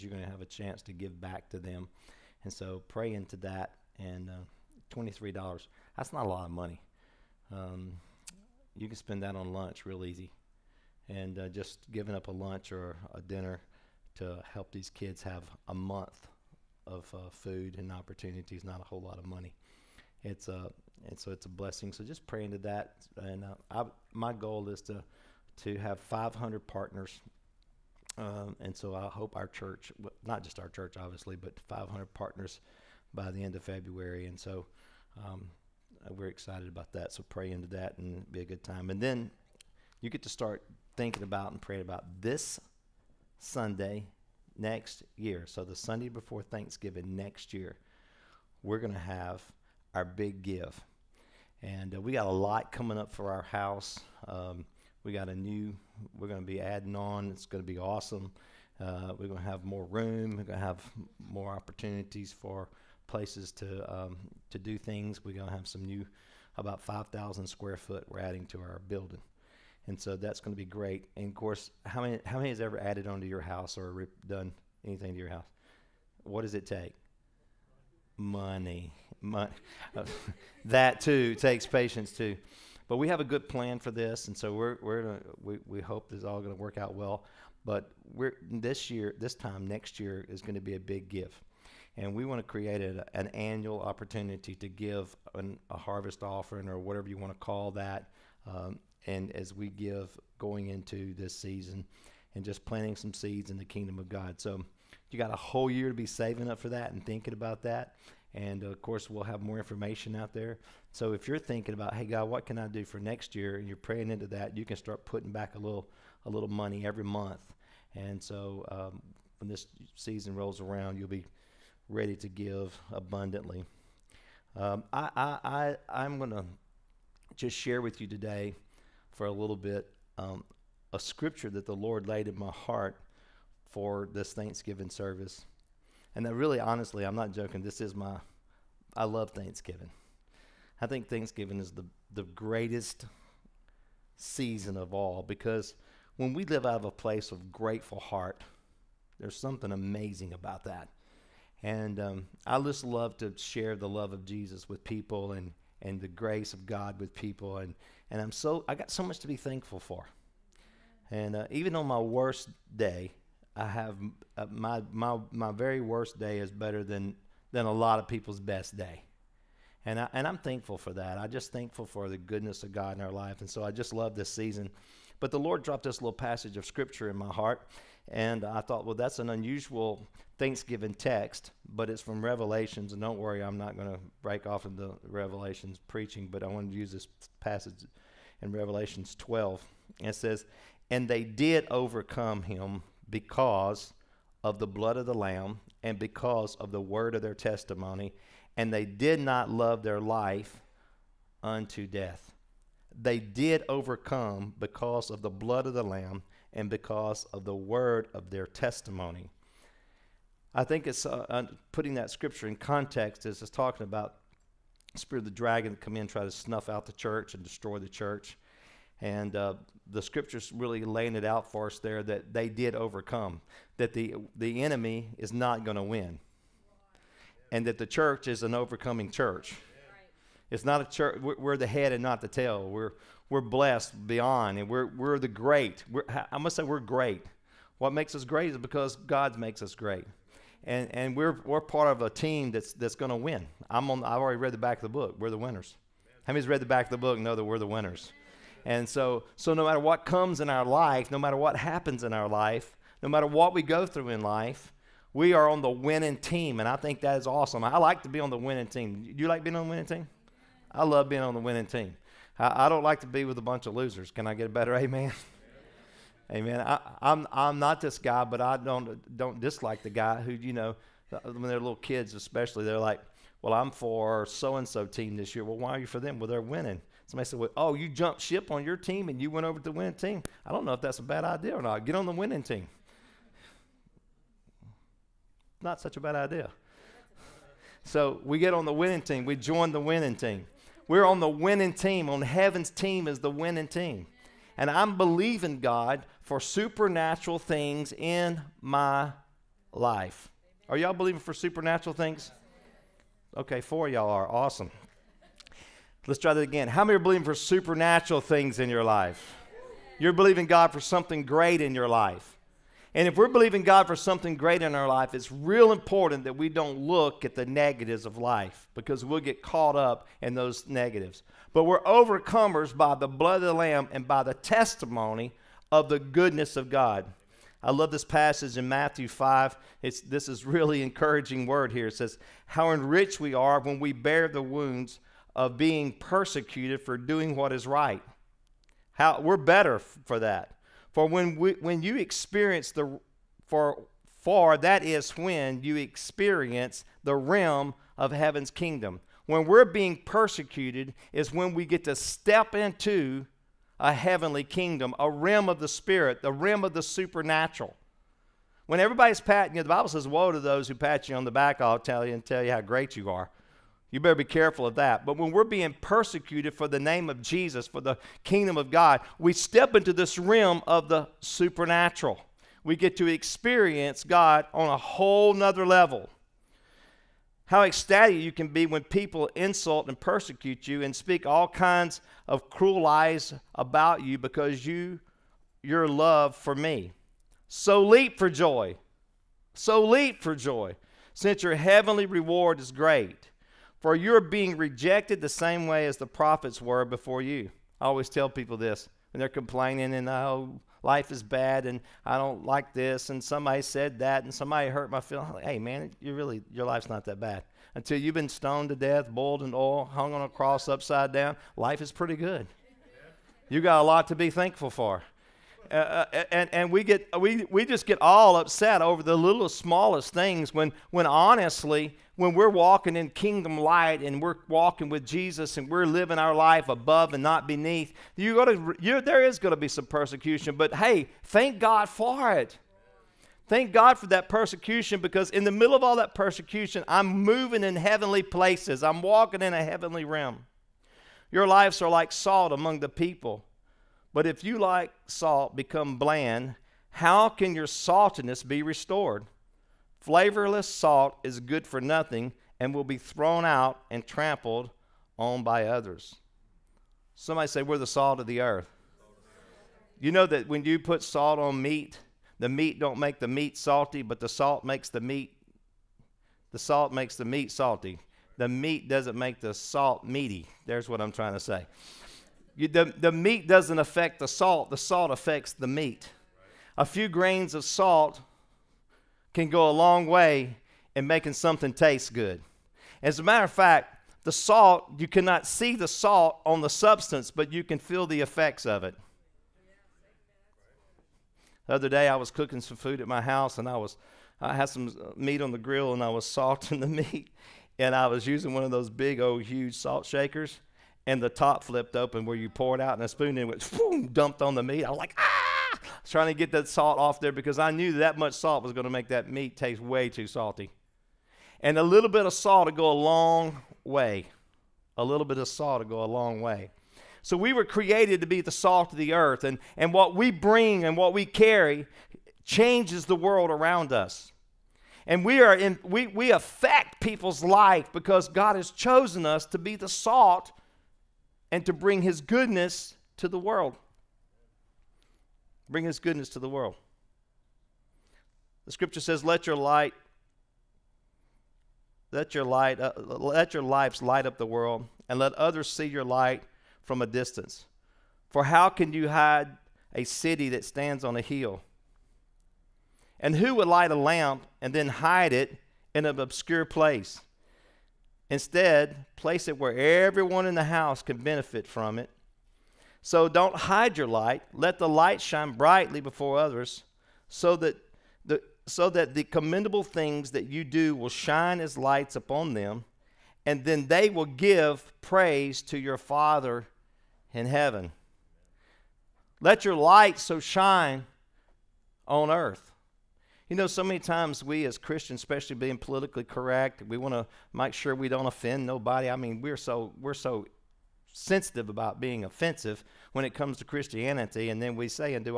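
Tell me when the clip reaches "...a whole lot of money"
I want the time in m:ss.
0:18.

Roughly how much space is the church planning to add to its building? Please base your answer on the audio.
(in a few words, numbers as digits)
5,000 square feet.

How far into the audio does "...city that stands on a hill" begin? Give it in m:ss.
9:10.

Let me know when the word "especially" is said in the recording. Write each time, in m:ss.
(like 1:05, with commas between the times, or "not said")
4:32, 9:45.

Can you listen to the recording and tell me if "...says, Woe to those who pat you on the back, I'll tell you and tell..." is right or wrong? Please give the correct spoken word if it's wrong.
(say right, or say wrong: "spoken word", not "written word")
right.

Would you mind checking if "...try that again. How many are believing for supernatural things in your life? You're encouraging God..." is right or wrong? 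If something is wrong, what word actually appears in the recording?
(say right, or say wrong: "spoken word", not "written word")
wrong: "believing", not "encouraging".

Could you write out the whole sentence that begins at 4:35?
Well, why are you for them?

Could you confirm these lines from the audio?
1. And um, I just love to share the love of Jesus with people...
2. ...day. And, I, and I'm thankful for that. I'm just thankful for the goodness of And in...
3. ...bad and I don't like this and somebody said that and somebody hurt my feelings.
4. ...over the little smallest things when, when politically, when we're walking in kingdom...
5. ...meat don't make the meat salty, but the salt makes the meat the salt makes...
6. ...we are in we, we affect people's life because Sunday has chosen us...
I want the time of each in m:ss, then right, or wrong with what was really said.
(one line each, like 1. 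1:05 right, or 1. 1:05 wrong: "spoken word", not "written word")
1. 2:31 right
2. 2:48 wrong: "God", not "And"
3. 6:41 right
4. 6:58 wrong: "honestly", not "politically"
5. 7:42 right
6. 8:45 wrong: "God", not "Sunday".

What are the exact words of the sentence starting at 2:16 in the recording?
And that really, honestly, I'm not joking.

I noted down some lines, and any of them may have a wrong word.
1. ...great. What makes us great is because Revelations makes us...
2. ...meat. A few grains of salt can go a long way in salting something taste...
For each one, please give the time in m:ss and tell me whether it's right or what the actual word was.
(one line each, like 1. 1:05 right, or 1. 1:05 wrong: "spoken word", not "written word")
1. 3:56 wrong: "God", not "Revelations"
2. 7:55 wrong: "making", not "salting".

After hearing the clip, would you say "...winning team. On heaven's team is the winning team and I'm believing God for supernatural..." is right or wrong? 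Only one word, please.
right.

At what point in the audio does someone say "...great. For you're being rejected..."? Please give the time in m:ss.
6:32.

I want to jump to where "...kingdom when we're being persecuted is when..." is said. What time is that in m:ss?
5:48.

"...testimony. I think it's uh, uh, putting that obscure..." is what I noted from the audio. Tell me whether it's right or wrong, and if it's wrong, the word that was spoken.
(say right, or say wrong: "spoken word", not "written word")
wrong: "scripture", not "obscure".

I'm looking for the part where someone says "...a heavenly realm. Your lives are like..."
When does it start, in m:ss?
7:19.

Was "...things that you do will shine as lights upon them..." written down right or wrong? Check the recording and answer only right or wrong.
right.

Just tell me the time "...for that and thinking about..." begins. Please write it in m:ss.
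1:46.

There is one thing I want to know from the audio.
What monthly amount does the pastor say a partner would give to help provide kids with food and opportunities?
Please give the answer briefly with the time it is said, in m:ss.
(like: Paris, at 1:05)
$23, at 0:04.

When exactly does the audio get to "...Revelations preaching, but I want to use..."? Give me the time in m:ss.
3:05.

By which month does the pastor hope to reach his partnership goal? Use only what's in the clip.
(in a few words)
February.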